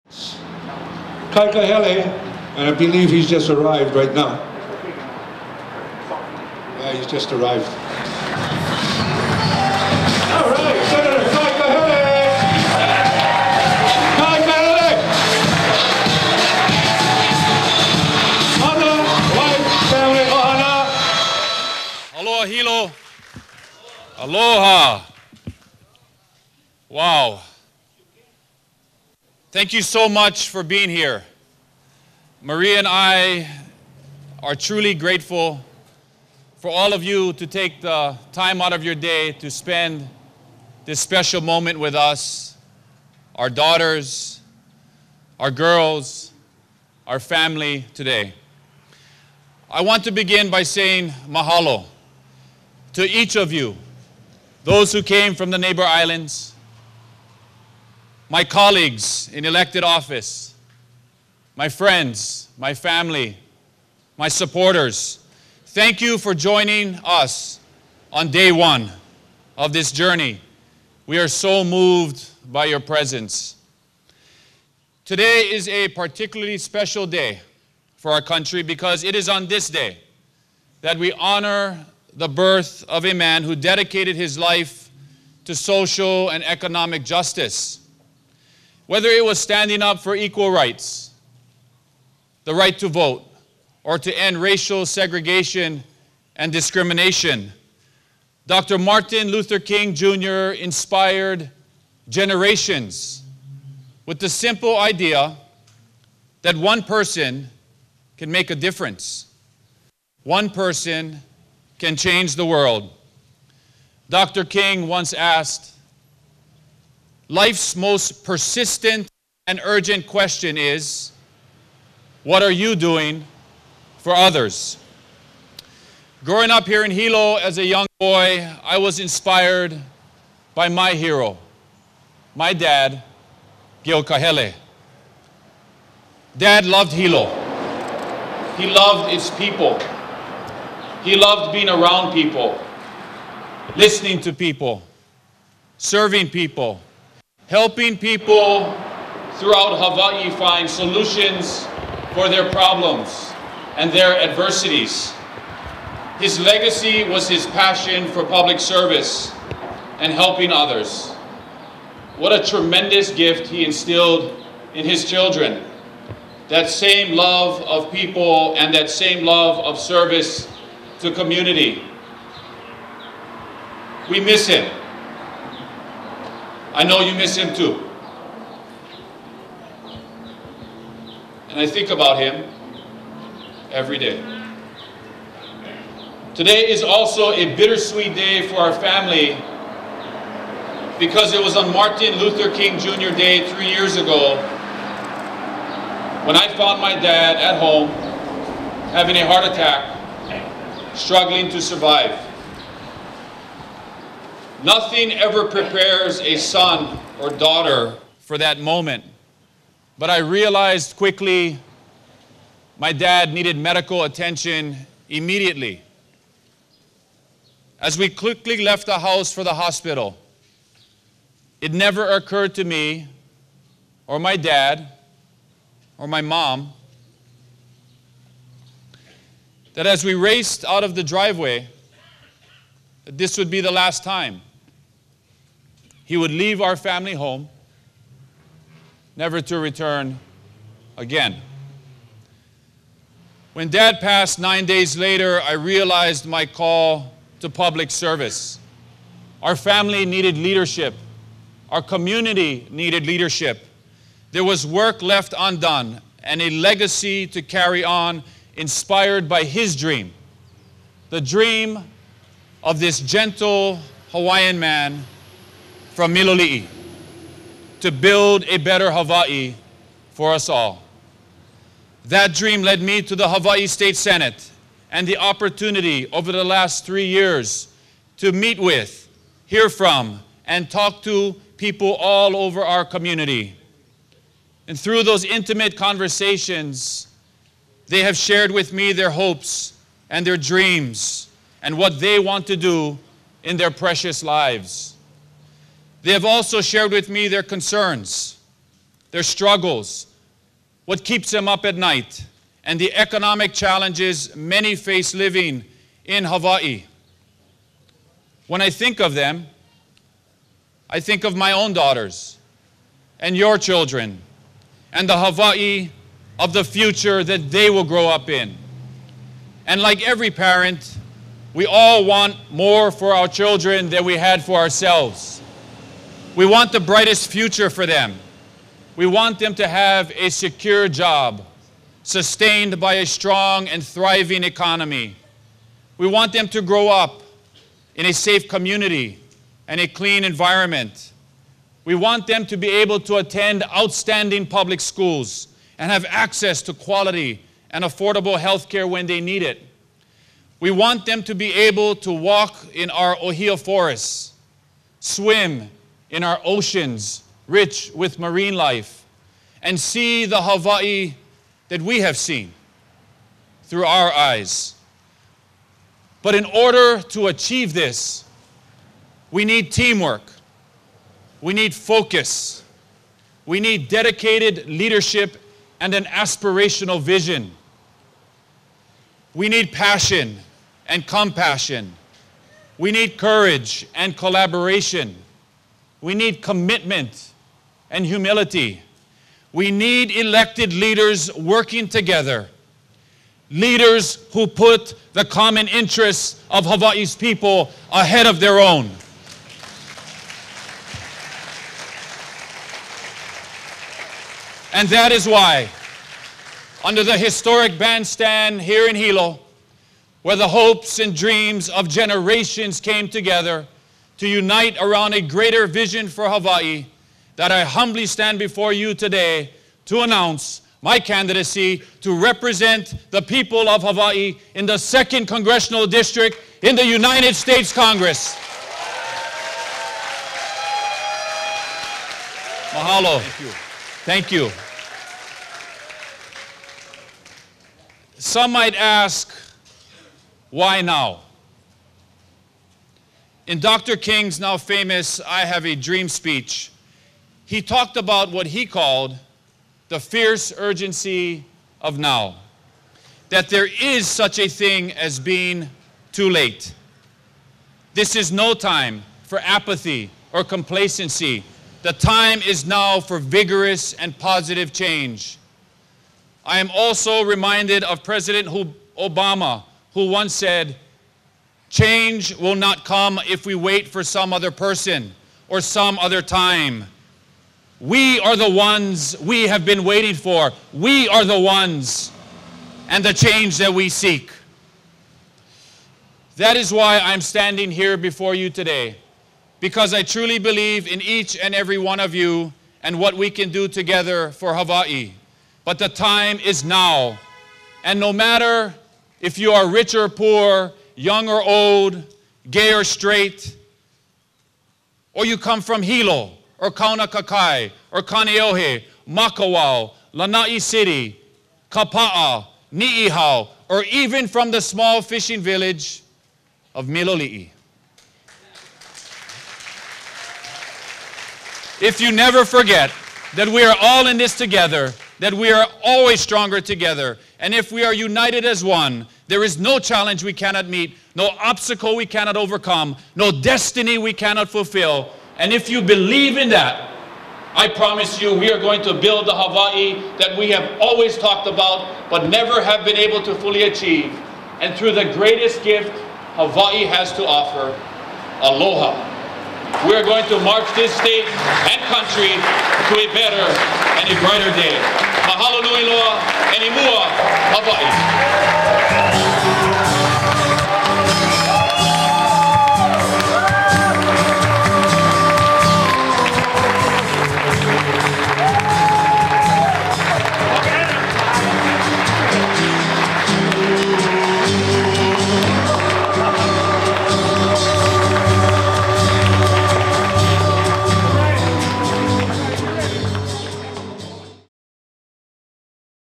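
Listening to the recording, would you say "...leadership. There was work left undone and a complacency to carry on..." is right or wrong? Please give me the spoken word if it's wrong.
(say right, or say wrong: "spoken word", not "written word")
wrong: "legacy", not "complacency".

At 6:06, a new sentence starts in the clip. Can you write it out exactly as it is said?
But in order to achieve this, we need teamwork, we need focus, we need dedicated leadership and an aspirational vision.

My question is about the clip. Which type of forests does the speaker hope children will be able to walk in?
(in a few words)
Ohia forests.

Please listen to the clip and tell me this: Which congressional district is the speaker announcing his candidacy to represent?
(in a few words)
Second.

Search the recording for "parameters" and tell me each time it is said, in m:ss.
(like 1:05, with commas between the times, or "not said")
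not said.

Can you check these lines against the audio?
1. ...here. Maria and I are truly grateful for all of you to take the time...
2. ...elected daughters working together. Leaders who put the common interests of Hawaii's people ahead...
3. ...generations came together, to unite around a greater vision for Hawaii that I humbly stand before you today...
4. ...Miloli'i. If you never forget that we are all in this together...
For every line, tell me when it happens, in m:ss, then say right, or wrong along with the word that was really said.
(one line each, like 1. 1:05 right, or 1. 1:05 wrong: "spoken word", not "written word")
1. 0:30 right
2. 6:30 wrong: "leaders", not "daughters"
3. 6:51 right
4. 8:36 right.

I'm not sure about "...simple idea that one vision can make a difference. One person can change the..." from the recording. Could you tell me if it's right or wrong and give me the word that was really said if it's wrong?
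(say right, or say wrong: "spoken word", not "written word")
wrong: "person", not "vision".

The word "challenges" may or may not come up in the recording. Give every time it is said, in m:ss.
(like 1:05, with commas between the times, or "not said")
5:03, 8:49.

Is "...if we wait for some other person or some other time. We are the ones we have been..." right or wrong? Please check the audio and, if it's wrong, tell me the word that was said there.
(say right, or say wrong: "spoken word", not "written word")
right.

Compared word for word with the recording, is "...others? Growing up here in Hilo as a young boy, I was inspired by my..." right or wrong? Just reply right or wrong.
right.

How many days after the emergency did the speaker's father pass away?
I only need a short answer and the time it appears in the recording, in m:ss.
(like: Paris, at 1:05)
9, at 4:04.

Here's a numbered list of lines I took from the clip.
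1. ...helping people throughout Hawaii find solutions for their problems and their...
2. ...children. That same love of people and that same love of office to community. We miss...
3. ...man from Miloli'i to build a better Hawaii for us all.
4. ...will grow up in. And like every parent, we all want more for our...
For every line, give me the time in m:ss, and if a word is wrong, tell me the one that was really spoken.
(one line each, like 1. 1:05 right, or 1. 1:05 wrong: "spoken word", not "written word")
1. 2:27 right
2. 2:45 wrong: "service", not "office"
3. 4:24 right
4. 5:17 right.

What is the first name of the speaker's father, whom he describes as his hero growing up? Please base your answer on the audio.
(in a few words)
Gil.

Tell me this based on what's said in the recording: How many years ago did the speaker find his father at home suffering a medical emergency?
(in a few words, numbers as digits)
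3.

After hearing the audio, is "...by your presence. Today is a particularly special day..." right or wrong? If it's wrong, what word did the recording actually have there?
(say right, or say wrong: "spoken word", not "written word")
right.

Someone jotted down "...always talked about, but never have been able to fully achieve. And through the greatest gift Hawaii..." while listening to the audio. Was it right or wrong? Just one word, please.
right.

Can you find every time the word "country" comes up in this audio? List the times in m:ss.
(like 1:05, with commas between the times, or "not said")
1:18, 9:11.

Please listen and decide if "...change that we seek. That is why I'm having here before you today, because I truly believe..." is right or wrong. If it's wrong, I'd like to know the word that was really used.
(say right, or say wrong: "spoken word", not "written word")
wrong: "standing", not "having".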